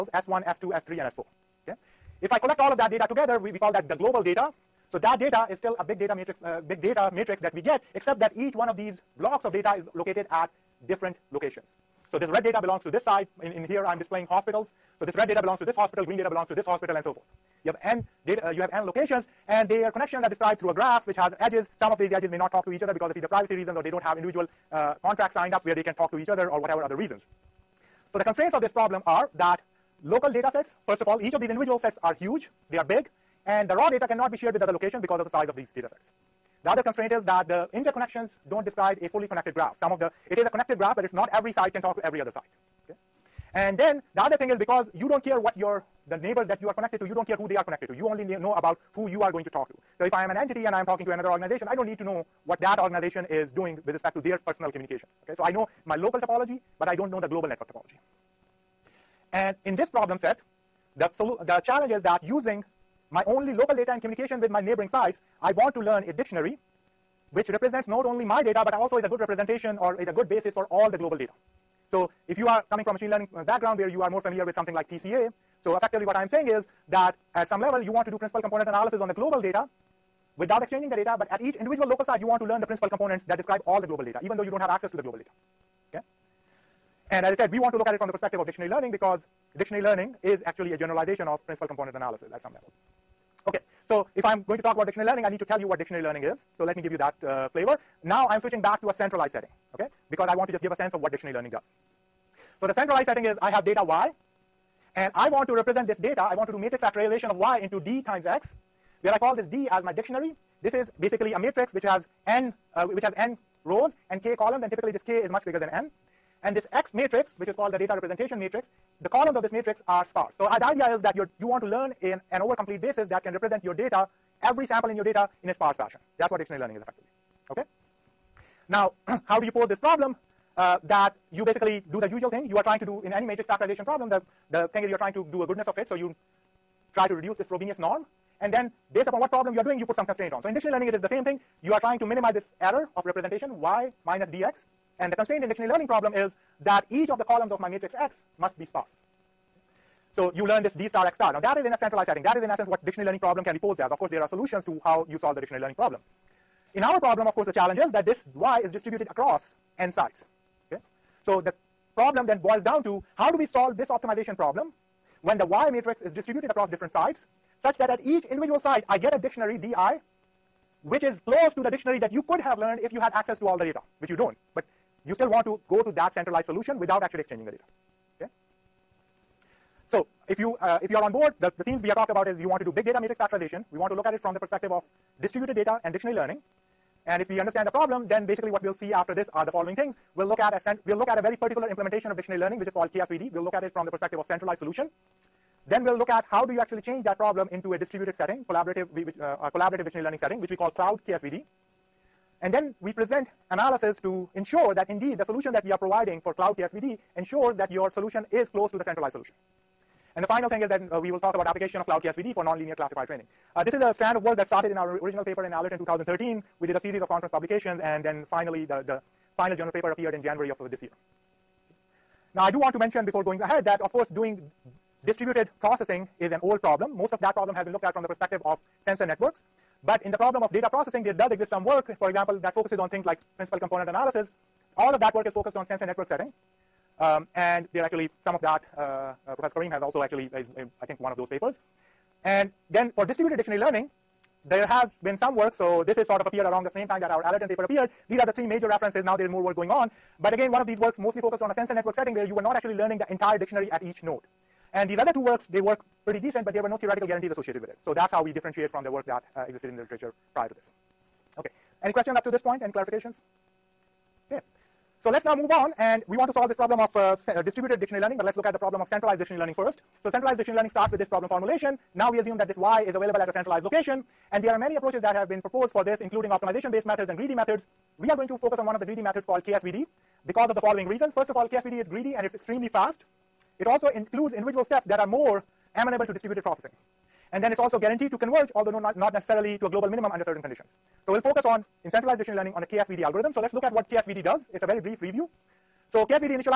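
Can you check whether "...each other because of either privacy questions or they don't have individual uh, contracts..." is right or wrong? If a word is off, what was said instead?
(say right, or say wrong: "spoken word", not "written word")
wrong: "reasons", not "questions".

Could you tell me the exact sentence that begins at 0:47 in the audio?
You only know about who you are going to talk to.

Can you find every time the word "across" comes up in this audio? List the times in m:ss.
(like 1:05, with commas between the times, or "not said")
2:39, 2:46.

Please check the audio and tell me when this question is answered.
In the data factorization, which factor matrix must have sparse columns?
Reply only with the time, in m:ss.
1:57.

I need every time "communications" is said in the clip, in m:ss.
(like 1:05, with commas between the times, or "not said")
0:54, 1:04.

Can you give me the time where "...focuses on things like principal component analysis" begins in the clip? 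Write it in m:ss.
3:52.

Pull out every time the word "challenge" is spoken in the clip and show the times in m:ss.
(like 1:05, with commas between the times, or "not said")
1:01, 2:37.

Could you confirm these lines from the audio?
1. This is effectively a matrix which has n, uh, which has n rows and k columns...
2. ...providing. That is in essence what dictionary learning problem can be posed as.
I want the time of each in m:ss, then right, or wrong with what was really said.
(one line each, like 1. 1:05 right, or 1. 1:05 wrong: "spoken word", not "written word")
1. 1:50 wrong: "basically", not "effectively"
2. 2:32 wrong: "setting", not "providing".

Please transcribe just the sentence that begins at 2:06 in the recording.
That's what dictionary learning is effectively.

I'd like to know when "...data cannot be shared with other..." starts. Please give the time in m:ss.
0:33.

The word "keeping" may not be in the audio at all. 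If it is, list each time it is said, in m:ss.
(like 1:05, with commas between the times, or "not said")
not said.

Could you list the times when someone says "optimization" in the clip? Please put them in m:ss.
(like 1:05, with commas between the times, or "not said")
2:43, 4:36.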